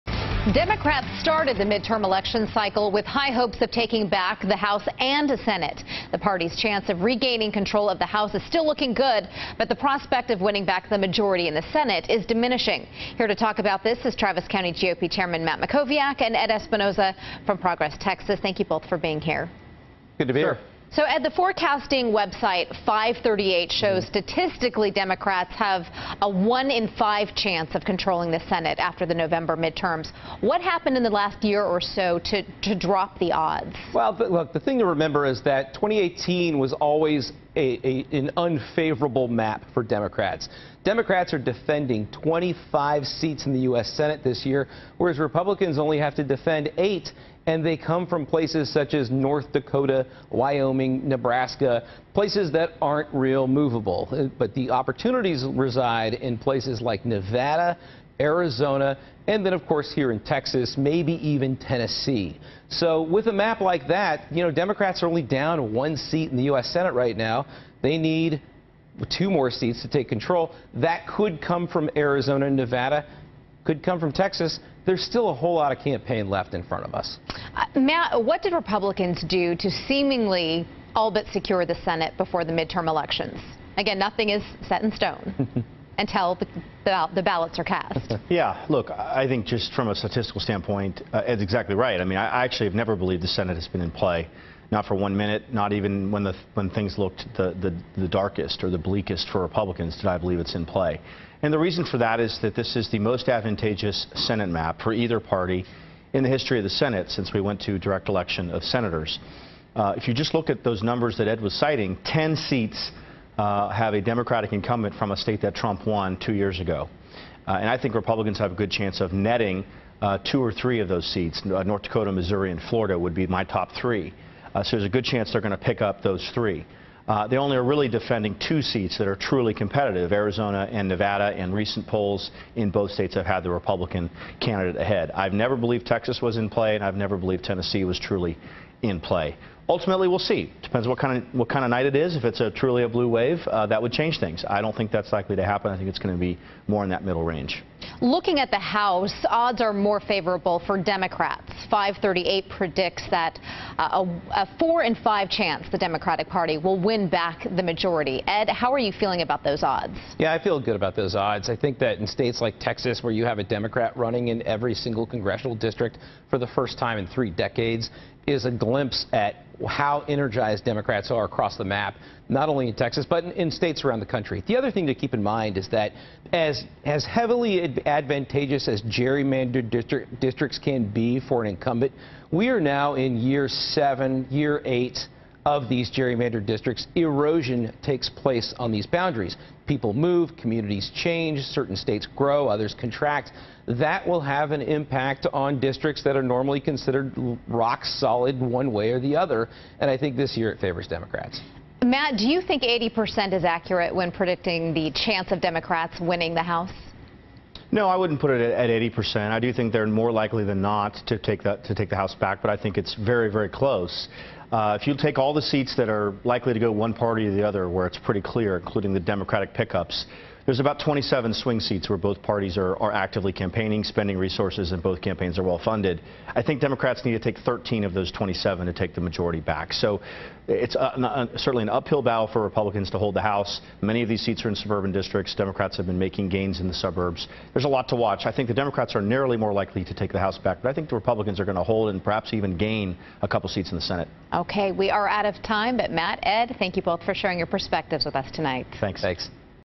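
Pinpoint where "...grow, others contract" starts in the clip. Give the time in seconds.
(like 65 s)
192 s.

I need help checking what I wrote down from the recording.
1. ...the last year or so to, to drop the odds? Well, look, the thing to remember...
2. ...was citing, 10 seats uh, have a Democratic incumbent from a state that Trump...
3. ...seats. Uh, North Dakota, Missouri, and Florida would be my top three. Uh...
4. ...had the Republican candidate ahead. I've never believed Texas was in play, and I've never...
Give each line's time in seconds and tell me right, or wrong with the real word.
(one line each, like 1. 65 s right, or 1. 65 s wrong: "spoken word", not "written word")
1. 31 s right
2. 111 s right
3. 121 s right
4. 133 s right.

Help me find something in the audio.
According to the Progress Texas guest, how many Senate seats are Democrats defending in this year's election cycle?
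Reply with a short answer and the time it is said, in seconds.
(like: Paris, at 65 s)
25, at 42 s.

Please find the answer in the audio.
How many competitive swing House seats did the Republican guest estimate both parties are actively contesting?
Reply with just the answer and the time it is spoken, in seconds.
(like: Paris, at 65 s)
27, at 220 s.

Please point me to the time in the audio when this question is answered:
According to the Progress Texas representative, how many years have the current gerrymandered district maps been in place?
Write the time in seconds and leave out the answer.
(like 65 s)
183 s.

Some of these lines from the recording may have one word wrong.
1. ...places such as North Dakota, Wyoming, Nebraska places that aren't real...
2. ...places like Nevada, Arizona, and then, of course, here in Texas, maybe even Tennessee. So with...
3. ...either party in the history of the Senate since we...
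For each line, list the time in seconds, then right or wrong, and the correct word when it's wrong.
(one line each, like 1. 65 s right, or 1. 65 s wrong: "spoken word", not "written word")
1. 48 s right
2. 56 s right
3. 104 s right.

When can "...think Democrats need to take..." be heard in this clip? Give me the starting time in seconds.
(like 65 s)
226 s.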